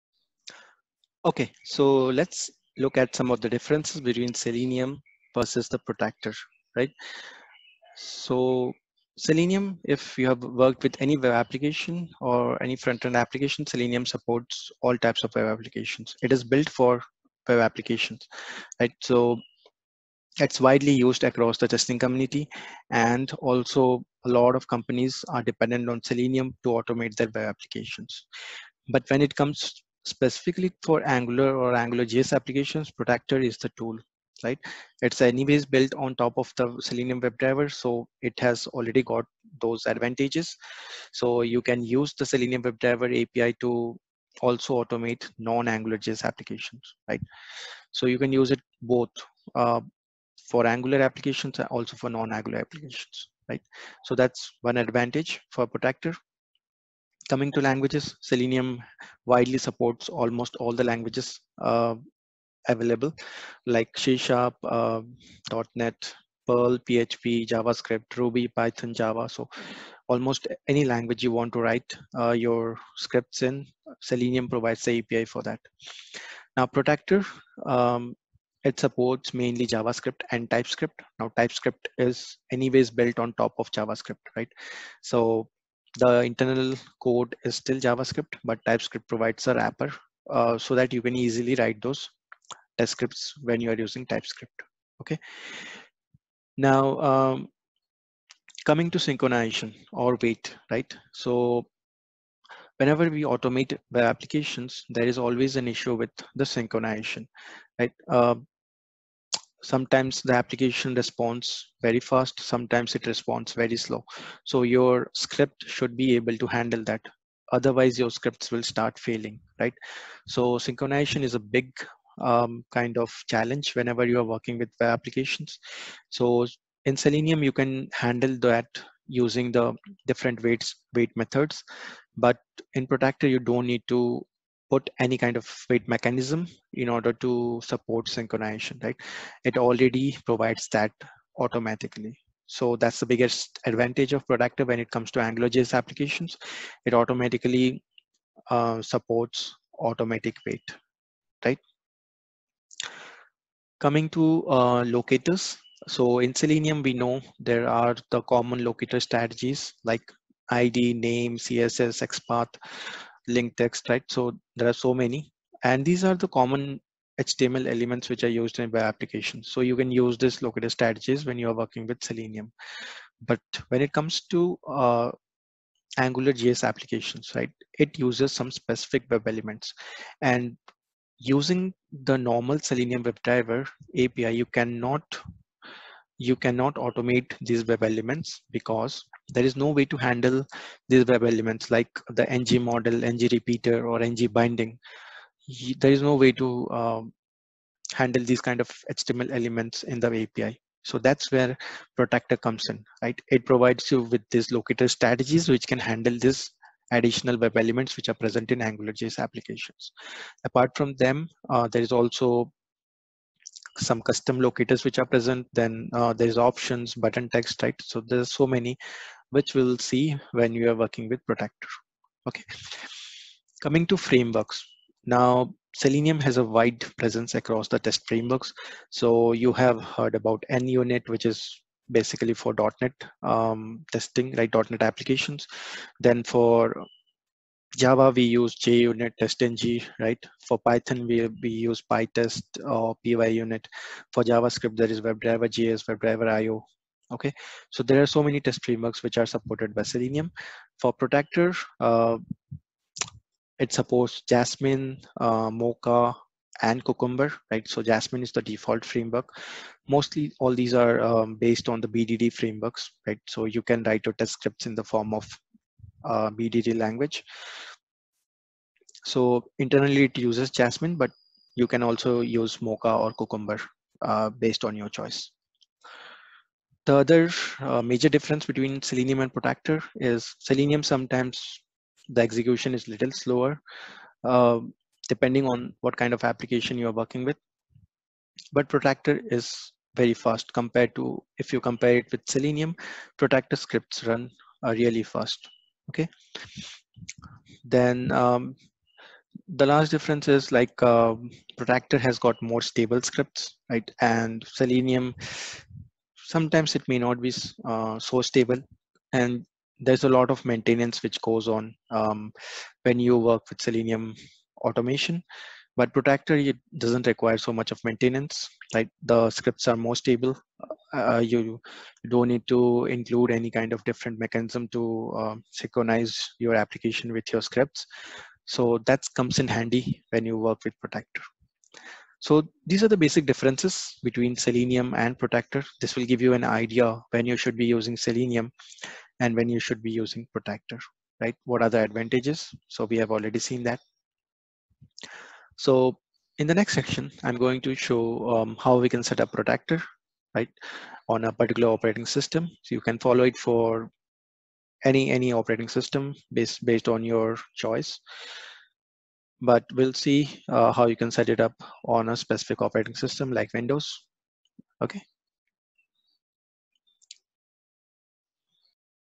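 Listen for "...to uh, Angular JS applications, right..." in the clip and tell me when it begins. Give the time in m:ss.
2:54.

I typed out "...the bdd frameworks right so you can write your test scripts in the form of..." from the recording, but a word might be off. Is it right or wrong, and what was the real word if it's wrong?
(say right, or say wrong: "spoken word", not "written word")
right.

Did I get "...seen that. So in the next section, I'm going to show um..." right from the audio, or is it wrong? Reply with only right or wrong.
right.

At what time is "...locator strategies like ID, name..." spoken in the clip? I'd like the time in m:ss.
2:38.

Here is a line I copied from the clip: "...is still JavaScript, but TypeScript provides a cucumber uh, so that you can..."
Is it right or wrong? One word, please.
wrong.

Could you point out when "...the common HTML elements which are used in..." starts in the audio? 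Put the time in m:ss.
2:46.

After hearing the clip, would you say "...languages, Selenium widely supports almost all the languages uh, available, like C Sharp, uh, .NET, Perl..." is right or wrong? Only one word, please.
right.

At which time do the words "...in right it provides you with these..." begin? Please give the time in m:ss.
3:22.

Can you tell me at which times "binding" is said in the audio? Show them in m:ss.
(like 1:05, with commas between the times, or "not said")
3:14.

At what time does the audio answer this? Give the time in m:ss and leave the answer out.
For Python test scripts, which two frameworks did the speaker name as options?
4:01.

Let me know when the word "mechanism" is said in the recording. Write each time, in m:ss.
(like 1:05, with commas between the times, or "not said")
2:15, 5:24.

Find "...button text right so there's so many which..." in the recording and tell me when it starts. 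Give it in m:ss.
3:37.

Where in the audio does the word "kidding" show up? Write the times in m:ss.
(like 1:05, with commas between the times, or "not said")
not said.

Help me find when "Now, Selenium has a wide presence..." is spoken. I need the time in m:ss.
3:45.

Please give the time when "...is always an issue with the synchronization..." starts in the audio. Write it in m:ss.
1:45.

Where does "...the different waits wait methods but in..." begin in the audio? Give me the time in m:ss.
2:09.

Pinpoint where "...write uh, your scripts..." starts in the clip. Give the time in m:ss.
1:11.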